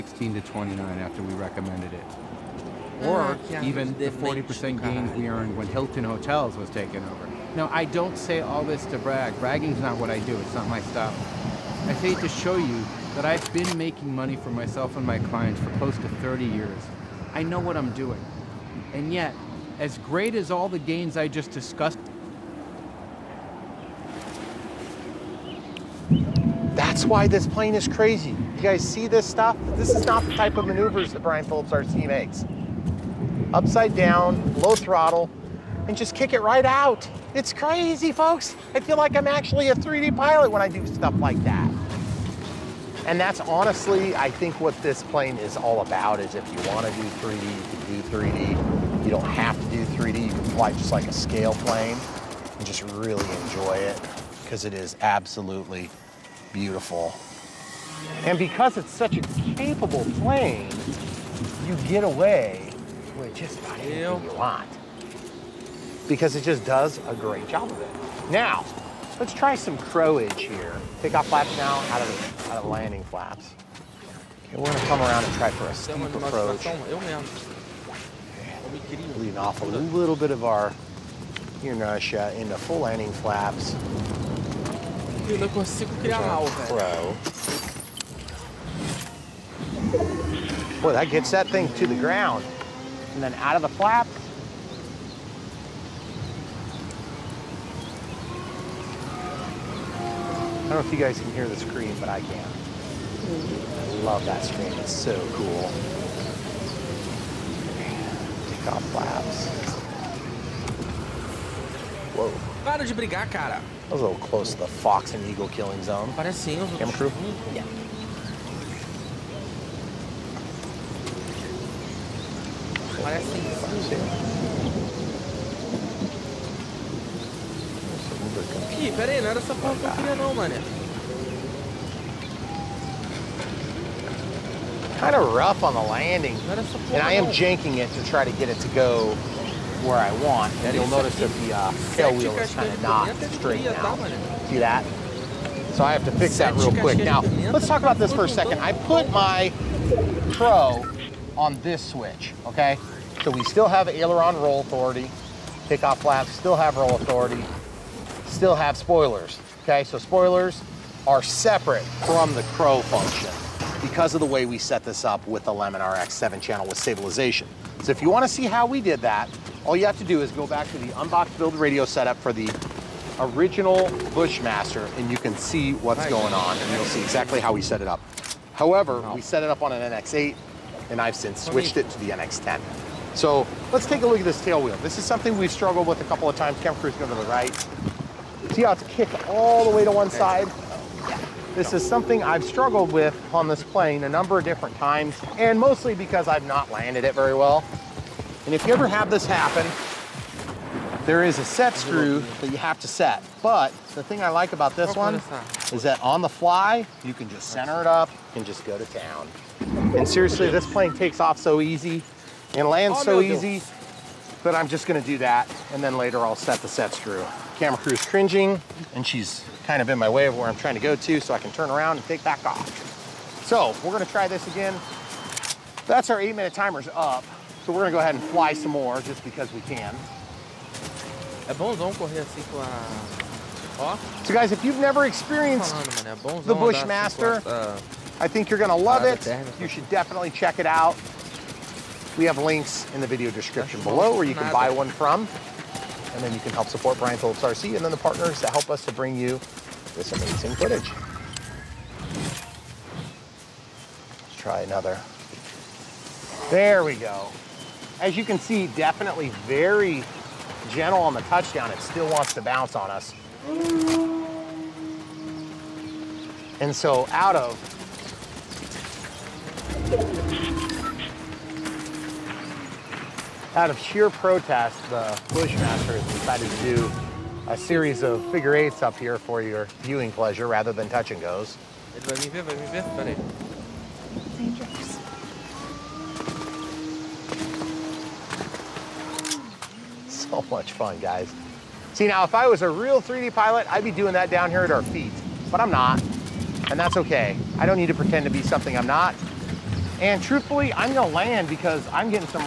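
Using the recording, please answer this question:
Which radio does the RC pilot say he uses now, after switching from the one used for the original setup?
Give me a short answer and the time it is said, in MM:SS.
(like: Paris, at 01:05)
NX10, at 03:02.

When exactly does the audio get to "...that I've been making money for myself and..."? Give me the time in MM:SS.
00:13.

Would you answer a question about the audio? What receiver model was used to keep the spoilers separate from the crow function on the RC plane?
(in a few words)
Lemon RX 7 channel.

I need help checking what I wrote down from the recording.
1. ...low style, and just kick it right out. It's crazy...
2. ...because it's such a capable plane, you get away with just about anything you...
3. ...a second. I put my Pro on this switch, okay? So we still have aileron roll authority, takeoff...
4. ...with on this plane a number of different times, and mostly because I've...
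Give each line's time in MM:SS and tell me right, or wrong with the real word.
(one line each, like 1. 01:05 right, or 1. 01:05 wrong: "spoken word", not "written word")
1. 00:34 wrong: "throttle", not "style"
2. 00:58 right
3. 02:28 right
4. 03:12 right.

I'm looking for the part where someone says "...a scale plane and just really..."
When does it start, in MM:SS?
00:51.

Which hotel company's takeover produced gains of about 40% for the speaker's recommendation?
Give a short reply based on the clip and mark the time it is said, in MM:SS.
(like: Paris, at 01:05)
Hilton Hotels, at 00:05.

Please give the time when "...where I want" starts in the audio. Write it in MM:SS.
02:19.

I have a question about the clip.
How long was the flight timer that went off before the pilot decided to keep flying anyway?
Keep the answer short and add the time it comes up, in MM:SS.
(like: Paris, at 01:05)
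8 minutes, at 03:46.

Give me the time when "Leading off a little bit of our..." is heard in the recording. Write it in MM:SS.
01:19.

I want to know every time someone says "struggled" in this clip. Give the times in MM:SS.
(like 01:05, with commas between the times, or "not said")
03:05, 03:12.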